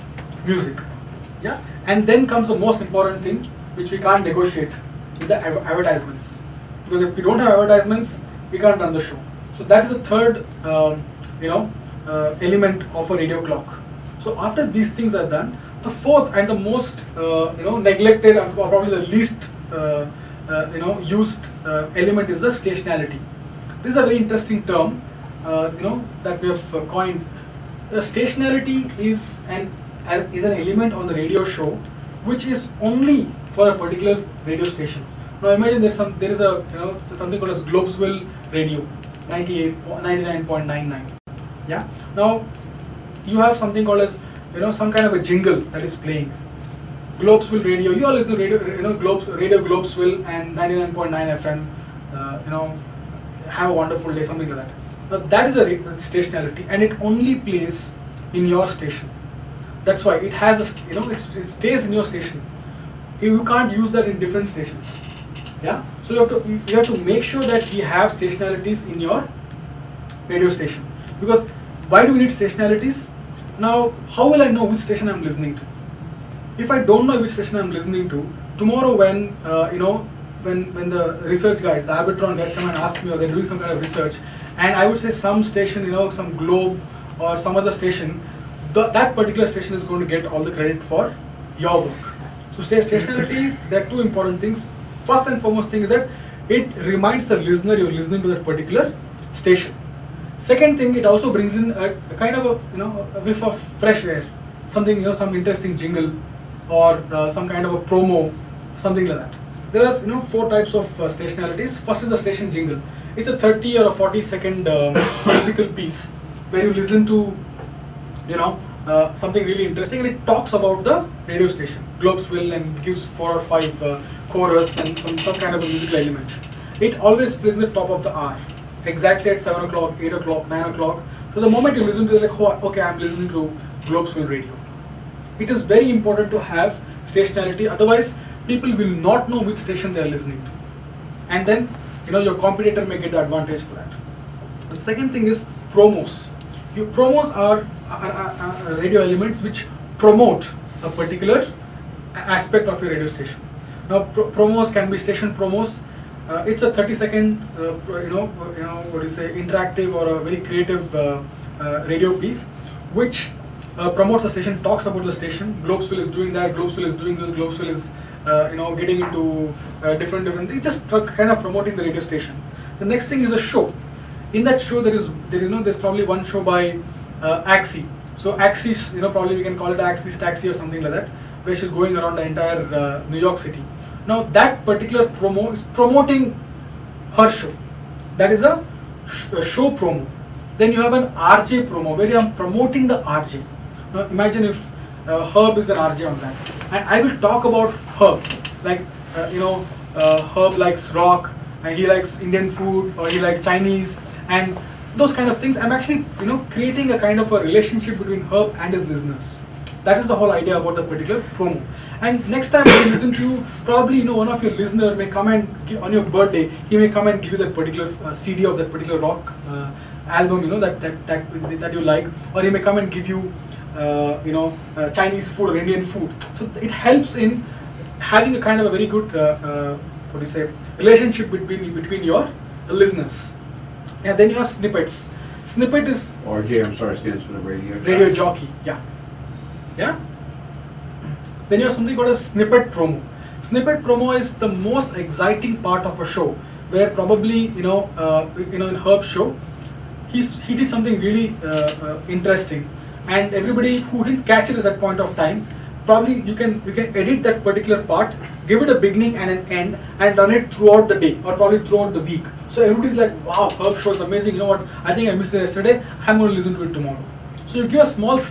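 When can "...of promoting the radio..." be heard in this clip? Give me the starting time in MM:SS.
02:51.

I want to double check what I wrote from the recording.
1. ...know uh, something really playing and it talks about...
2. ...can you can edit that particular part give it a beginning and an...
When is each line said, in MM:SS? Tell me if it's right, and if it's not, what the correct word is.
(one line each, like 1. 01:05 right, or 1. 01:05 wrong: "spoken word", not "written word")
1. 01:58 wrong: "interesting", not "playing"
2. 04:16 right.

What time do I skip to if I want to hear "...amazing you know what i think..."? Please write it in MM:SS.
04:24.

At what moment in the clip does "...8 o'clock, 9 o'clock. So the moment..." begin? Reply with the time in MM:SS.
02:09.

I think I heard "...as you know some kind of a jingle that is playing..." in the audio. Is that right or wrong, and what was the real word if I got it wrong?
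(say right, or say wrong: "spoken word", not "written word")
right.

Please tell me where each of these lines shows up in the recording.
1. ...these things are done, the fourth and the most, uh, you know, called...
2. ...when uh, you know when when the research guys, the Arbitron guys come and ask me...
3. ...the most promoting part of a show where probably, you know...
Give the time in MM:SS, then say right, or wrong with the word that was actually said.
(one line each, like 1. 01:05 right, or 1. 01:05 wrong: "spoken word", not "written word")
1. 00:14 wrong: "neglected", not "called"
2. 01:18 right
3. 04:04 wrong: "exciting", not "promoting".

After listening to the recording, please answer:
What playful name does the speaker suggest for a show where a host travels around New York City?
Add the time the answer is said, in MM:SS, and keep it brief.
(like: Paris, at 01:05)
Axie's Taxi, at 02:59.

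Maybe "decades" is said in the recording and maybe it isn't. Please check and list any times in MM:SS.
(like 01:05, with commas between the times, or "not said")
not said.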